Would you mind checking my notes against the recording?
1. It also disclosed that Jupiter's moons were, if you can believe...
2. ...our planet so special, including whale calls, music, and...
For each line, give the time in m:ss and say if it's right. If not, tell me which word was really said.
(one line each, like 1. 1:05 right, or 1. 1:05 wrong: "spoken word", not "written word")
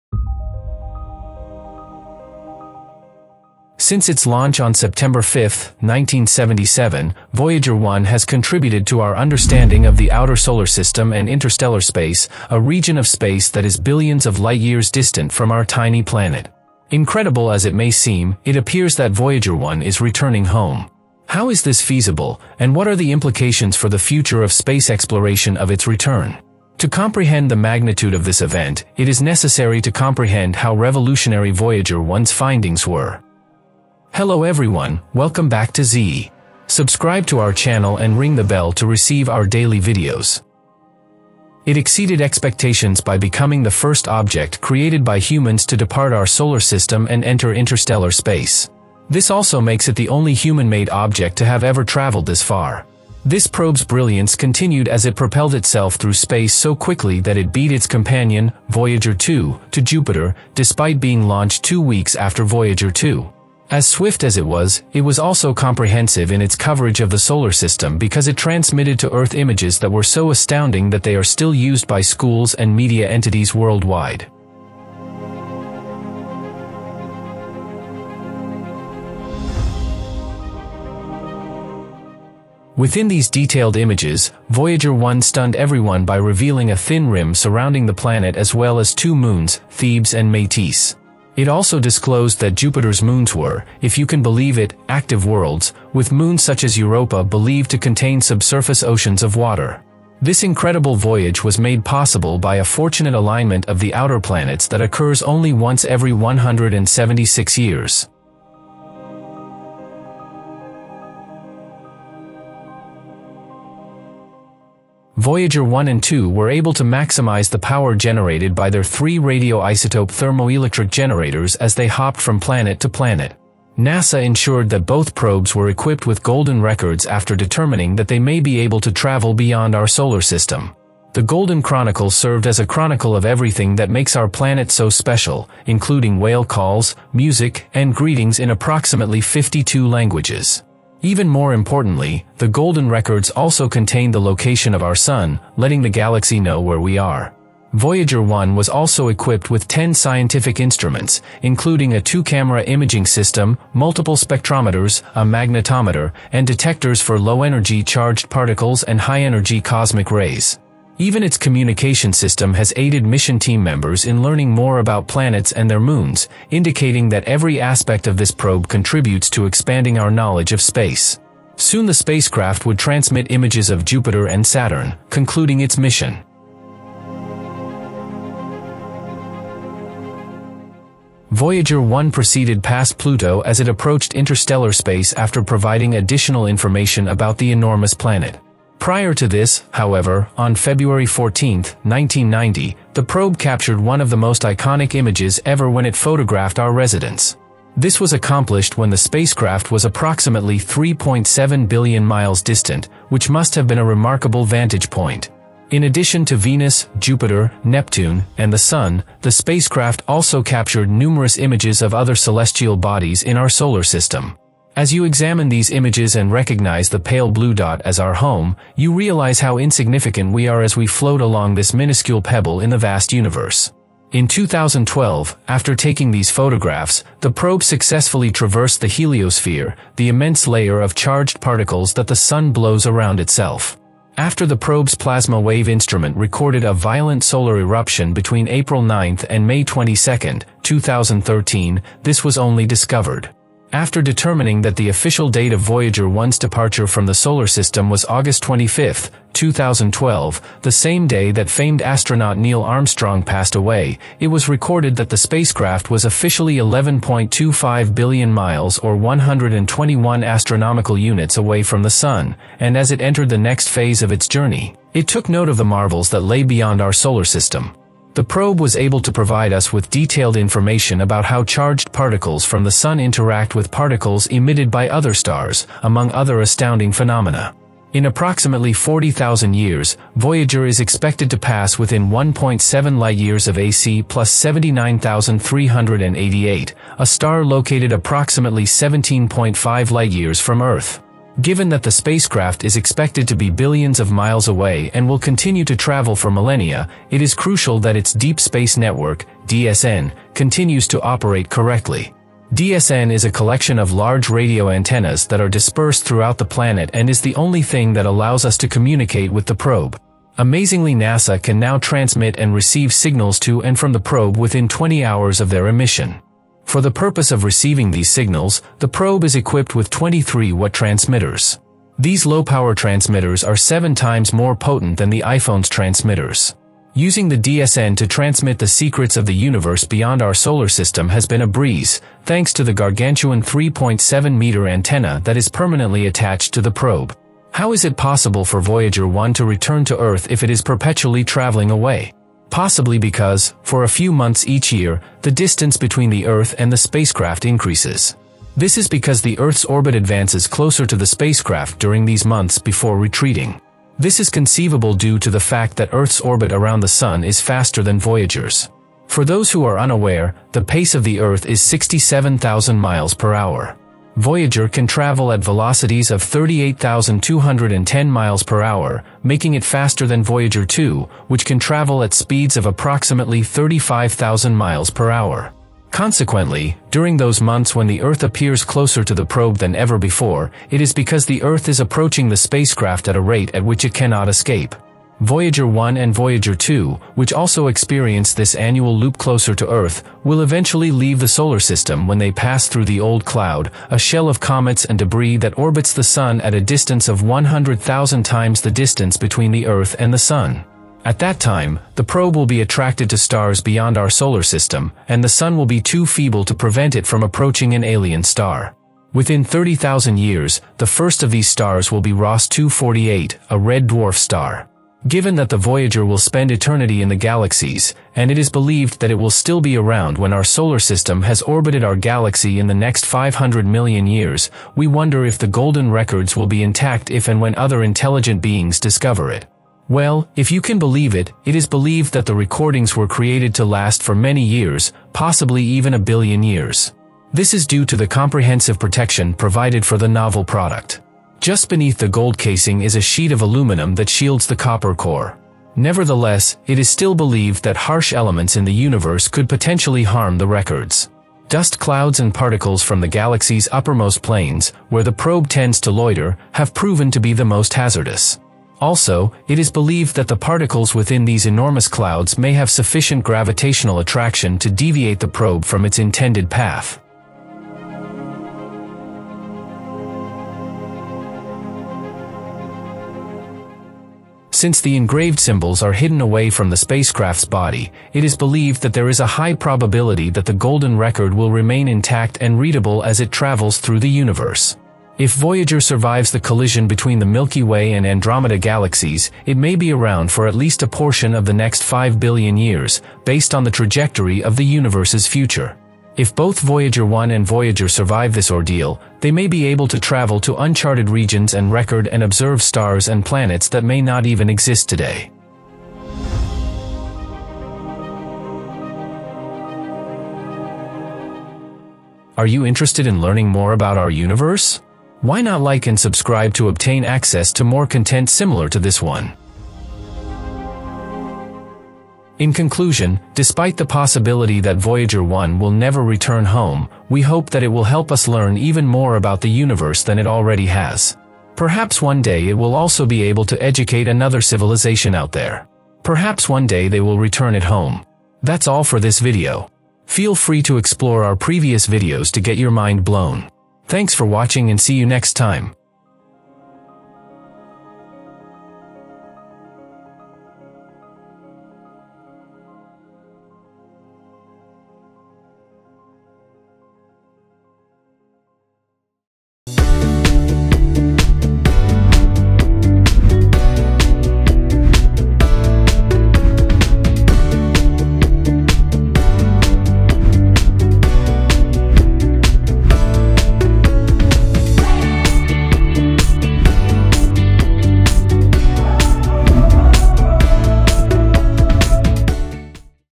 1. 1:31 right
2. 2:14 right.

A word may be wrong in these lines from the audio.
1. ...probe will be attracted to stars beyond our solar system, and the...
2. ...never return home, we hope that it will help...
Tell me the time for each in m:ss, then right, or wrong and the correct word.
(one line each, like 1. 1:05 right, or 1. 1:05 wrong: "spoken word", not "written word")
1. 6:42 right
2. 8:45 right.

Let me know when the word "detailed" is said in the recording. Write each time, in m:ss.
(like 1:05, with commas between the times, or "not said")
1:23, 4:29.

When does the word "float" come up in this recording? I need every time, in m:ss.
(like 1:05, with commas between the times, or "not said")
3:40.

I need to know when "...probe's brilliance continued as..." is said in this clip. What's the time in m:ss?
0:53.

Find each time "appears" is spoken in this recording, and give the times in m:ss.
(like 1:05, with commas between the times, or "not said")
0:18, 6:18.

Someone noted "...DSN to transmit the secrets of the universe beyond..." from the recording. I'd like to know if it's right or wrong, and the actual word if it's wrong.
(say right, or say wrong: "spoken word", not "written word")
right.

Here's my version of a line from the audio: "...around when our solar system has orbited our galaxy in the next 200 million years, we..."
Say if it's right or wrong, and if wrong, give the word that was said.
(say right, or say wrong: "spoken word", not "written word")
wrong: "500", not "200".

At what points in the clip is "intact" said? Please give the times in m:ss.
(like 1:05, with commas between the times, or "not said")
7:06, 8:01.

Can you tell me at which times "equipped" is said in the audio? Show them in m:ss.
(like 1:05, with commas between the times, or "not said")
2:05, 2:29, 5:19.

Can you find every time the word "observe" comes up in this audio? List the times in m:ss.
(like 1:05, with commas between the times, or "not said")
8:22.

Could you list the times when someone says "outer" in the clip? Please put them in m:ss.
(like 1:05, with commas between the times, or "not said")
0:10, 1:43.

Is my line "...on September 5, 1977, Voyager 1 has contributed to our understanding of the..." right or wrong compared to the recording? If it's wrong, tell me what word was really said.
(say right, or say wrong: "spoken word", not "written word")
right.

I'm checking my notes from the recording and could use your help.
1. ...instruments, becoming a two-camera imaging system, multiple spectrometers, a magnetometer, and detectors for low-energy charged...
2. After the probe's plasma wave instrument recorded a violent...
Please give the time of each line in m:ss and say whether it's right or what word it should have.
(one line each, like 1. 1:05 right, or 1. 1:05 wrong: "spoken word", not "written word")
1. 2:30 wrong: "including", not "becoming"
2. 3:54 right.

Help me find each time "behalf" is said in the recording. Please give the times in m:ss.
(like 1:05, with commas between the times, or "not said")
not said.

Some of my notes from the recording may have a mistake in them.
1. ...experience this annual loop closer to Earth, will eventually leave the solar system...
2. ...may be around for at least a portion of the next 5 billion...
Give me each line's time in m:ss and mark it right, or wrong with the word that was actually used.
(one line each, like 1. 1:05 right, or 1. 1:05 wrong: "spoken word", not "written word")
1. 6:27 right
2. 8:09 right.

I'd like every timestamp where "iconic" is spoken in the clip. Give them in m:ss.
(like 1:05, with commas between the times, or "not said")
3:14.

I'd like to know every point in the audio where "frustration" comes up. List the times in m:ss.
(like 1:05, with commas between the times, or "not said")
not said.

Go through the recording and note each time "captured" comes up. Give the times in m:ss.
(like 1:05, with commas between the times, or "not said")
3:13, 3:30.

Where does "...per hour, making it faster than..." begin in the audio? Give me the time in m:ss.
6:08.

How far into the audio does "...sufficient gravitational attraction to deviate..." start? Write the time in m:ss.
7:42.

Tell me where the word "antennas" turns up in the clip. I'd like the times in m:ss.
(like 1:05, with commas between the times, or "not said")
5:04, 5:34.